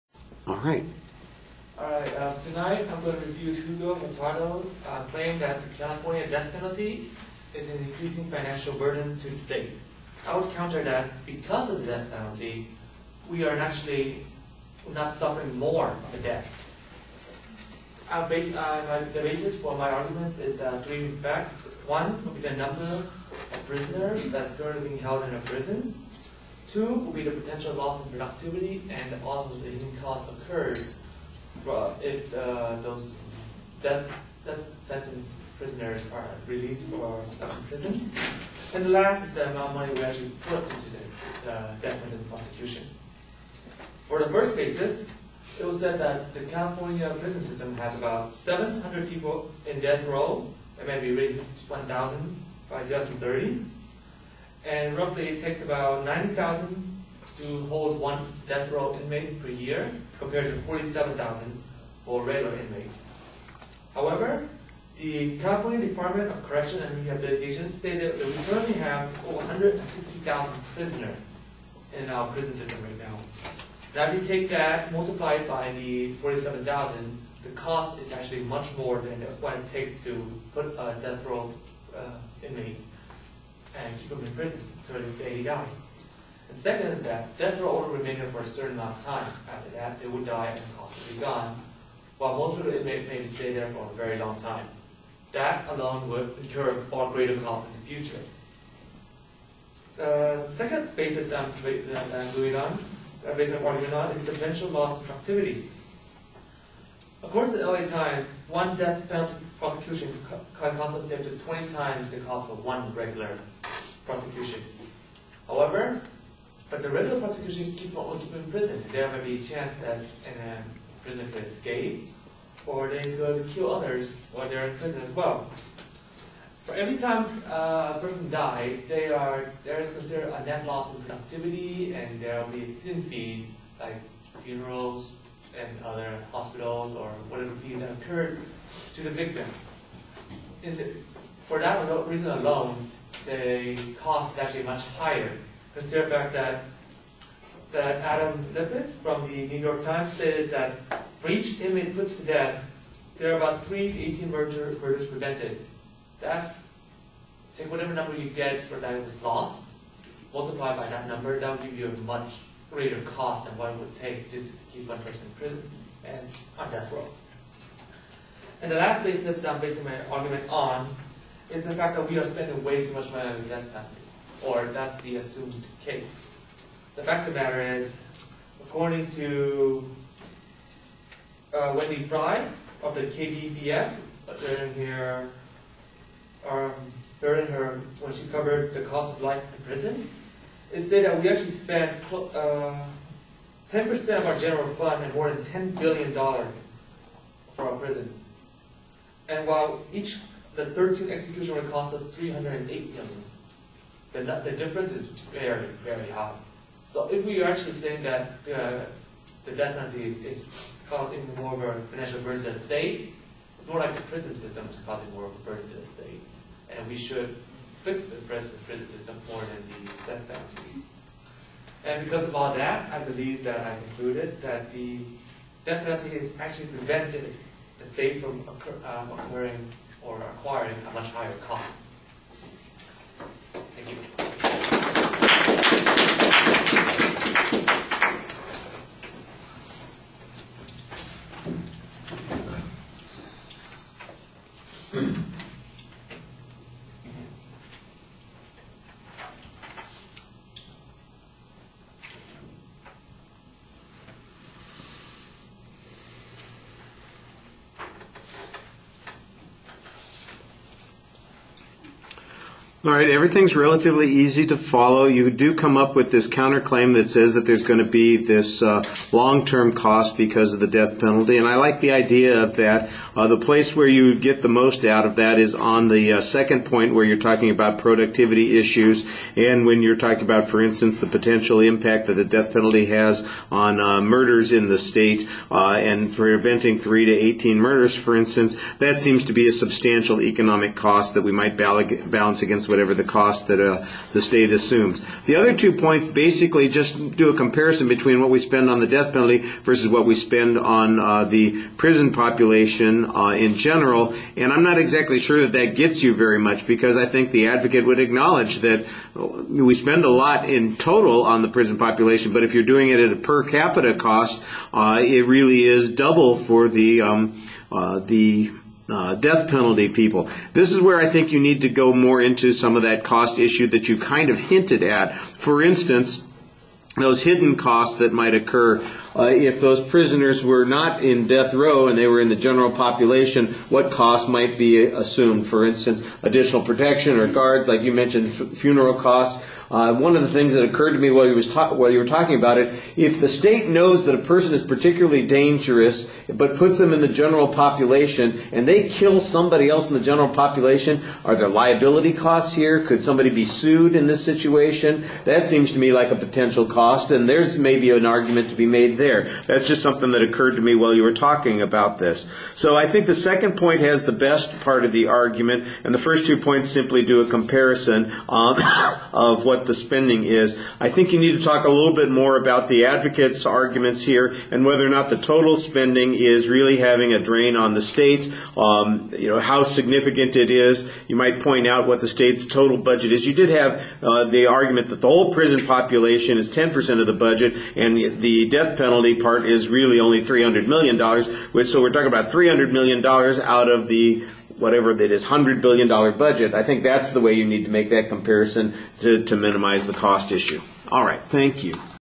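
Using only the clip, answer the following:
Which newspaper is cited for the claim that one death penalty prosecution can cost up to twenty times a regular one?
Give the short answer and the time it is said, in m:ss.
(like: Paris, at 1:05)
LA Times, at 1:47.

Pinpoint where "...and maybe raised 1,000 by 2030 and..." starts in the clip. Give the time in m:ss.
0:50.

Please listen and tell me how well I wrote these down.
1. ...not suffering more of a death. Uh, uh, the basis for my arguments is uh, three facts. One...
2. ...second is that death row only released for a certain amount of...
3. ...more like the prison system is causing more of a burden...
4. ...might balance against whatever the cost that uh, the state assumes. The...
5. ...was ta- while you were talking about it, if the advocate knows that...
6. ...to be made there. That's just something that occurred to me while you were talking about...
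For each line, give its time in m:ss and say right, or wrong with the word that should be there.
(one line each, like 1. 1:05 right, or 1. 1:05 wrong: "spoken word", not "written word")
1. 0:14 right
2. 1:26 wrong: "remained", not "released"
3. 3:33 right
4. 4:51 right
5. 5:41 wrong: "state", not "advocate"
6. 5:58 right.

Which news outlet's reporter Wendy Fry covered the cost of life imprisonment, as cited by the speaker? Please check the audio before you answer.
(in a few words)
KPBS.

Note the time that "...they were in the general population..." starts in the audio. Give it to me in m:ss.
5:31.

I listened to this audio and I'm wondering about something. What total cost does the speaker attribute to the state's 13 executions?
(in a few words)
308 million.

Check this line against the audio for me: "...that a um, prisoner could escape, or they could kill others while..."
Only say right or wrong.
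right.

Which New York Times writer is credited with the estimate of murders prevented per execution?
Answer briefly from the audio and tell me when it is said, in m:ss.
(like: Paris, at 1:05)
Adam Liptak, at 2:28.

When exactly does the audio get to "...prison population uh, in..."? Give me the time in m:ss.
5:01.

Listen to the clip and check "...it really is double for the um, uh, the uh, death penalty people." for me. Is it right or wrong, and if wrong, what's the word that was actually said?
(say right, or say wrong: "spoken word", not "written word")
right.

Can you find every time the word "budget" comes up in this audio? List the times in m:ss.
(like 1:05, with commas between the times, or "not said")
6:22, 6:27, 6:36.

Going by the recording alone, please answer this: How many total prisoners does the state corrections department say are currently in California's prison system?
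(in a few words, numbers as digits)
160,000.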